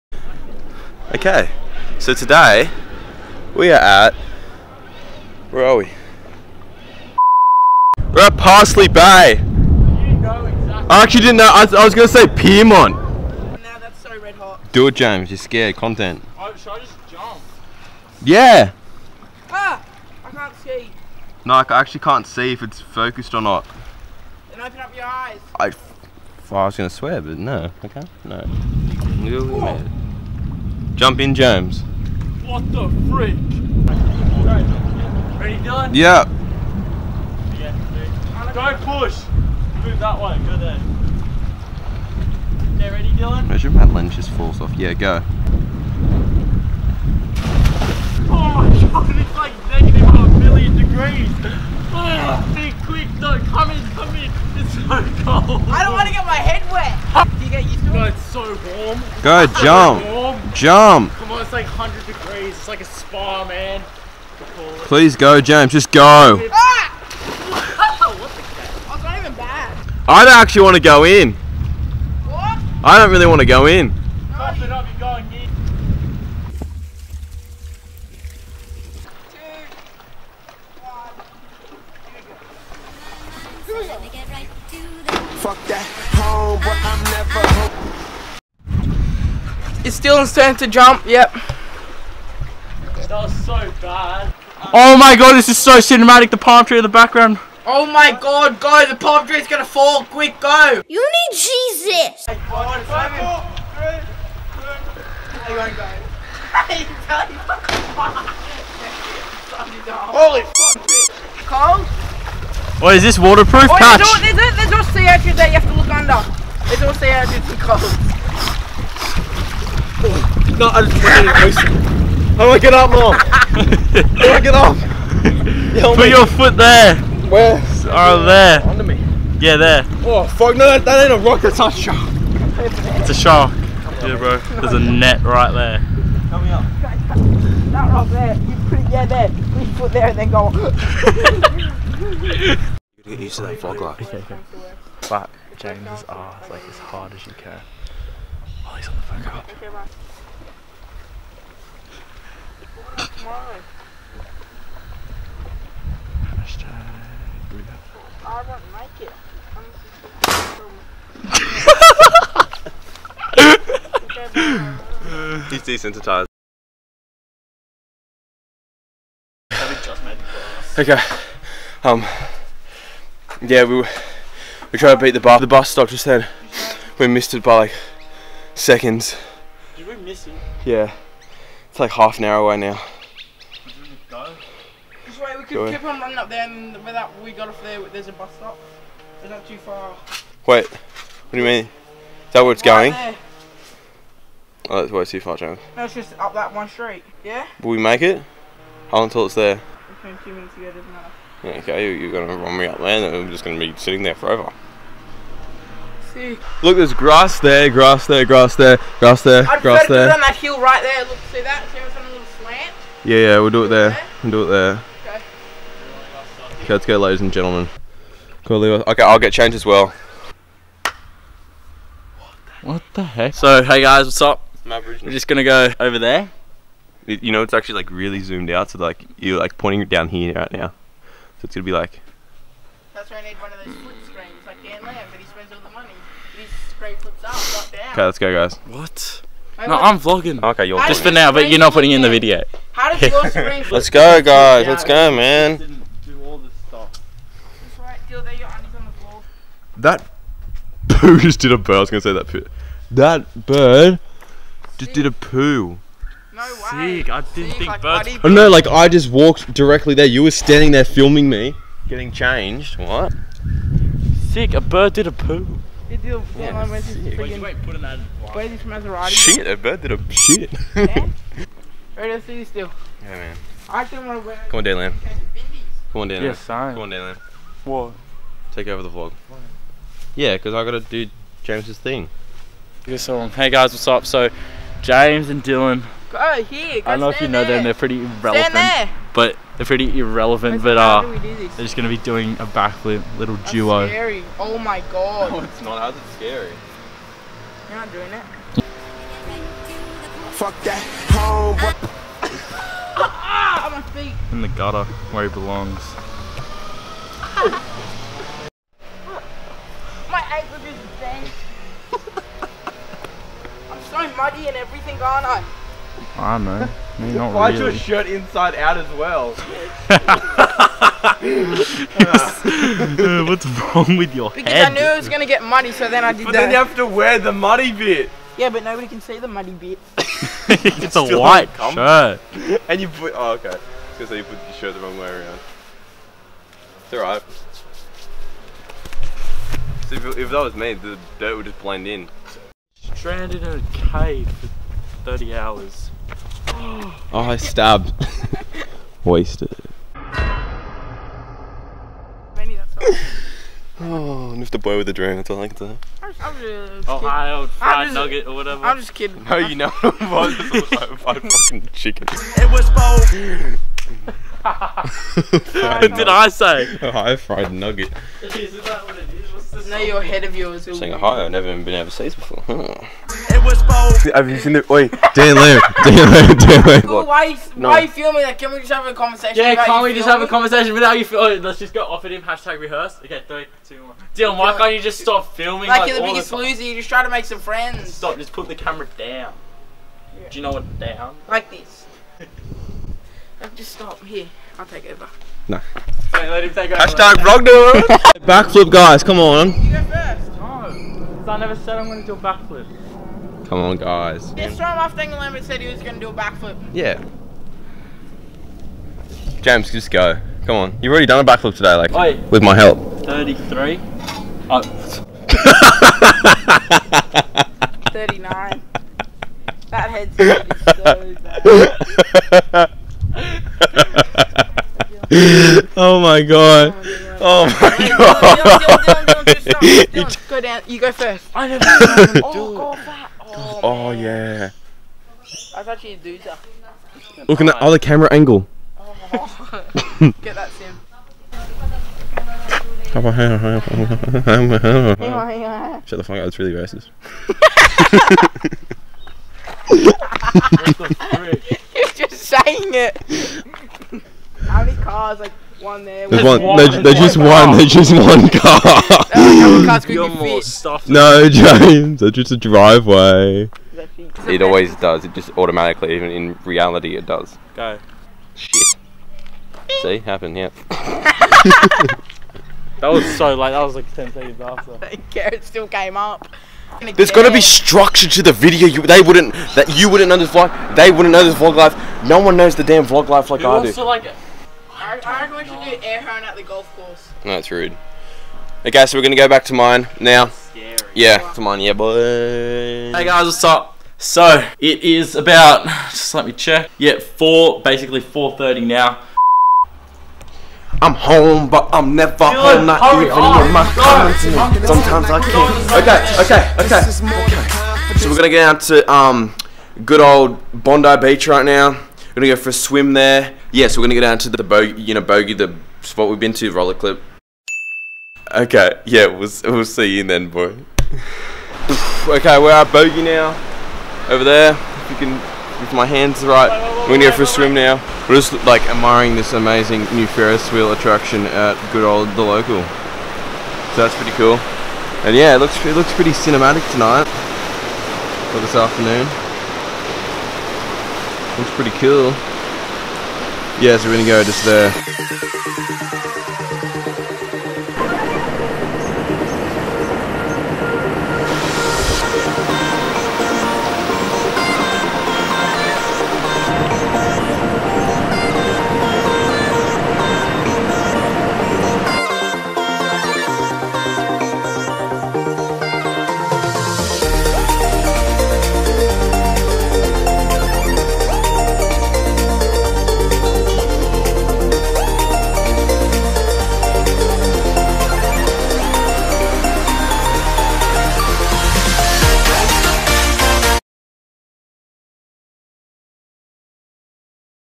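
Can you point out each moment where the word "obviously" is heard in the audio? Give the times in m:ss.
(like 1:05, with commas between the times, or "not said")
not said.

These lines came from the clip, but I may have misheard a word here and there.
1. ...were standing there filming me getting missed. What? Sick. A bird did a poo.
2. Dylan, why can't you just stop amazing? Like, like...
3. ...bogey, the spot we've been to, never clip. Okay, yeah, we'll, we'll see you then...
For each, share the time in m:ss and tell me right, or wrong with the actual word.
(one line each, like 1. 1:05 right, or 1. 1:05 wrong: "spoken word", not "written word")
1. 4:20 wrong: "changed", not "missed"
2. 6:24 wrong: "filming", not "amazing"
3. 8:35 wrong: "roller", not "never".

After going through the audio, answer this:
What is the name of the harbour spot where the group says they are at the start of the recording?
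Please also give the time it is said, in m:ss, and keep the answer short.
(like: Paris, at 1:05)
Parsley Bay, at 0:08.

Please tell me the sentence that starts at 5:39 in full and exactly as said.
So if, if, that was me, the dirt would just blend in.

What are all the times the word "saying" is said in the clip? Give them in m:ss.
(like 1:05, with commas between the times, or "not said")
6:10, 7:32.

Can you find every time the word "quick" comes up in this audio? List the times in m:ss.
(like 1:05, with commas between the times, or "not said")
0:52, 1:40.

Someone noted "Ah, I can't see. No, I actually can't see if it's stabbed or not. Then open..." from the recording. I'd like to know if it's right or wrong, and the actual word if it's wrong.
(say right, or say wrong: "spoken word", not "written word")
wrong: "focused", not "stabbed".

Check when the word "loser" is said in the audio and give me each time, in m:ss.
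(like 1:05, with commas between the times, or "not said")
6:26.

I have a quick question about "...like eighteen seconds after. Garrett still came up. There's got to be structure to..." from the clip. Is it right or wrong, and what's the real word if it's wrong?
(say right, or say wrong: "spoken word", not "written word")
wrong: "ten", not "eighteen".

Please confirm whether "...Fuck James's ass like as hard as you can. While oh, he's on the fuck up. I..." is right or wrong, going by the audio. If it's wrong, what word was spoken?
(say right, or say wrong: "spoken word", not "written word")
right.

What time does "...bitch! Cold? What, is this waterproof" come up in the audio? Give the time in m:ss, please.
1:50.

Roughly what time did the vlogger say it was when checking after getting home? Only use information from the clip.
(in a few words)
4:30.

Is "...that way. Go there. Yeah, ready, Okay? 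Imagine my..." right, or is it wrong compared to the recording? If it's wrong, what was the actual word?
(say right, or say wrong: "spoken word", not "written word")
wrong: "Dylan", not "Okay".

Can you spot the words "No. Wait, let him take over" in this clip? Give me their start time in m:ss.
6:35.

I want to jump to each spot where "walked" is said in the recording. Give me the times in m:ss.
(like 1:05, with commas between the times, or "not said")
4:19.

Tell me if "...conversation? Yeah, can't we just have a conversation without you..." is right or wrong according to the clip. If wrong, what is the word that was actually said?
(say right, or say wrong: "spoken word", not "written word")
right.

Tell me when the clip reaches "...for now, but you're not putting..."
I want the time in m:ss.
4:01.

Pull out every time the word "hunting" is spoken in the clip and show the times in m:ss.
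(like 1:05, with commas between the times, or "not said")
not said.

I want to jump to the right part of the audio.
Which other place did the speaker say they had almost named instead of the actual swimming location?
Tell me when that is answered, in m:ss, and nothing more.
0:12.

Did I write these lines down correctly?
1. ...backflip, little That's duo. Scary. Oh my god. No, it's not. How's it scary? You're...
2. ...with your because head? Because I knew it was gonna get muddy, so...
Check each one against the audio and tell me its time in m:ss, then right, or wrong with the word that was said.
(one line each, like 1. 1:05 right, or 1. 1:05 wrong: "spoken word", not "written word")
1. 4:52 right
2. 5:23 right.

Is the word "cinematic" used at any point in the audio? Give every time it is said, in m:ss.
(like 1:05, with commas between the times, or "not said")
1:35, 8:56.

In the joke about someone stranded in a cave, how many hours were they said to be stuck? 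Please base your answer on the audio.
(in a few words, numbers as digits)
30.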